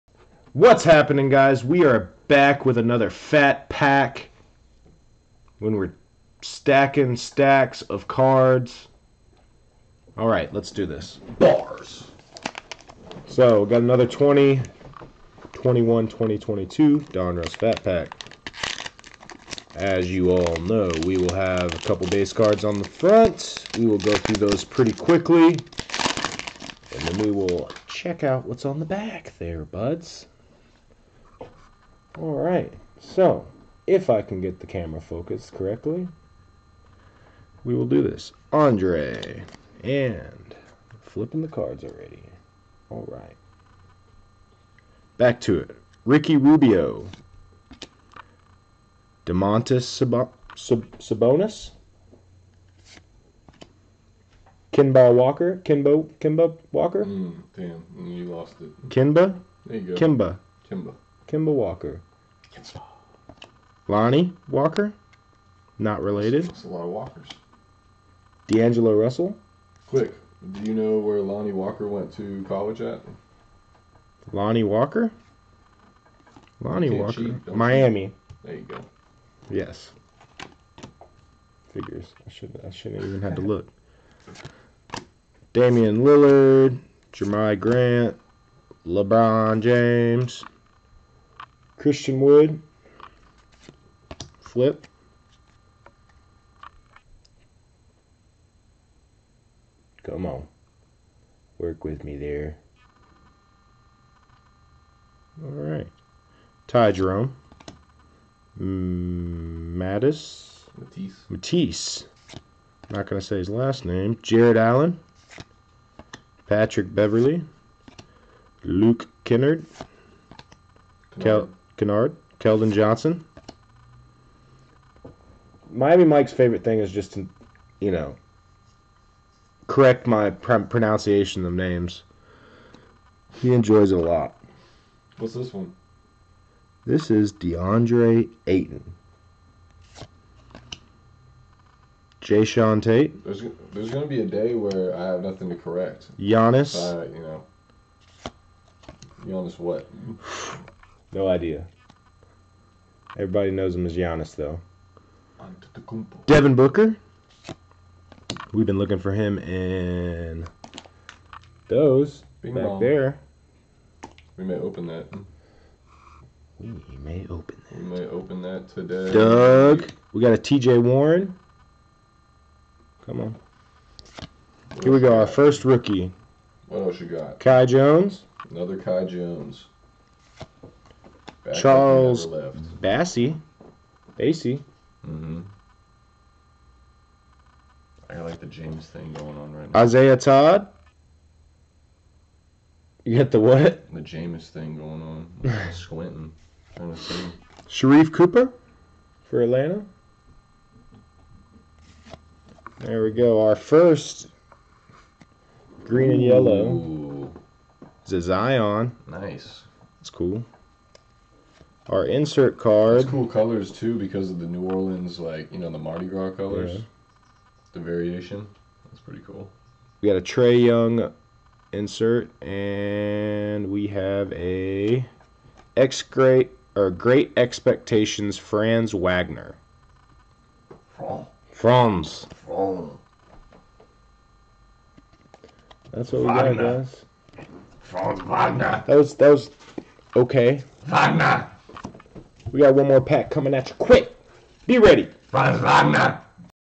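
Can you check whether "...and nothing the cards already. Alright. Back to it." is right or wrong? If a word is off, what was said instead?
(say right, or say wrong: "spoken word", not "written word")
wrong: "flipping", not "nothing".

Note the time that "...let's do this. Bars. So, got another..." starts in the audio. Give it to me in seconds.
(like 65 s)
10 s.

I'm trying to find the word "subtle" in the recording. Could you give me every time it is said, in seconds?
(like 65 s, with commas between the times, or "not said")
not said.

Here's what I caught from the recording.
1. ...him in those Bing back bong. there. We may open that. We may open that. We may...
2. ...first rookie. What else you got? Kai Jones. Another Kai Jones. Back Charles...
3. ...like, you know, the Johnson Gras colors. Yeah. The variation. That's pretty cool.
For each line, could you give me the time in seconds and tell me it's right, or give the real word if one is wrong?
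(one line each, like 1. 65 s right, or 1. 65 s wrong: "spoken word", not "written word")
1. 159 s right
2. 175 s right
3. 215 s wrong: "Mardi", not "Johnson".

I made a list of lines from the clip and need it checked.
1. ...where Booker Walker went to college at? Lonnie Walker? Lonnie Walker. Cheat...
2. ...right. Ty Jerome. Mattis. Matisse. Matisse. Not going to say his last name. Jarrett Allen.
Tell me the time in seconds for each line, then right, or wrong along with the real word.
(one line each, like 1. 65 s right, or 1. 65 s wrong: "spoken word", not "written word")
1. 70 s wrong: "Lonnie", not "Booker"
2. 105 s right.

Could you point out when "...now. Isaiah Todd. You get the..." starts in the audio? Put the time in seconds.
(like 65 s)
189 s.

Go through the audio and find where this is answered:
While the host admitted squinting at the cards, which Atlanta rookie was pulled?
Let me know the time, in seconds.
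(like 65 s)
197 s.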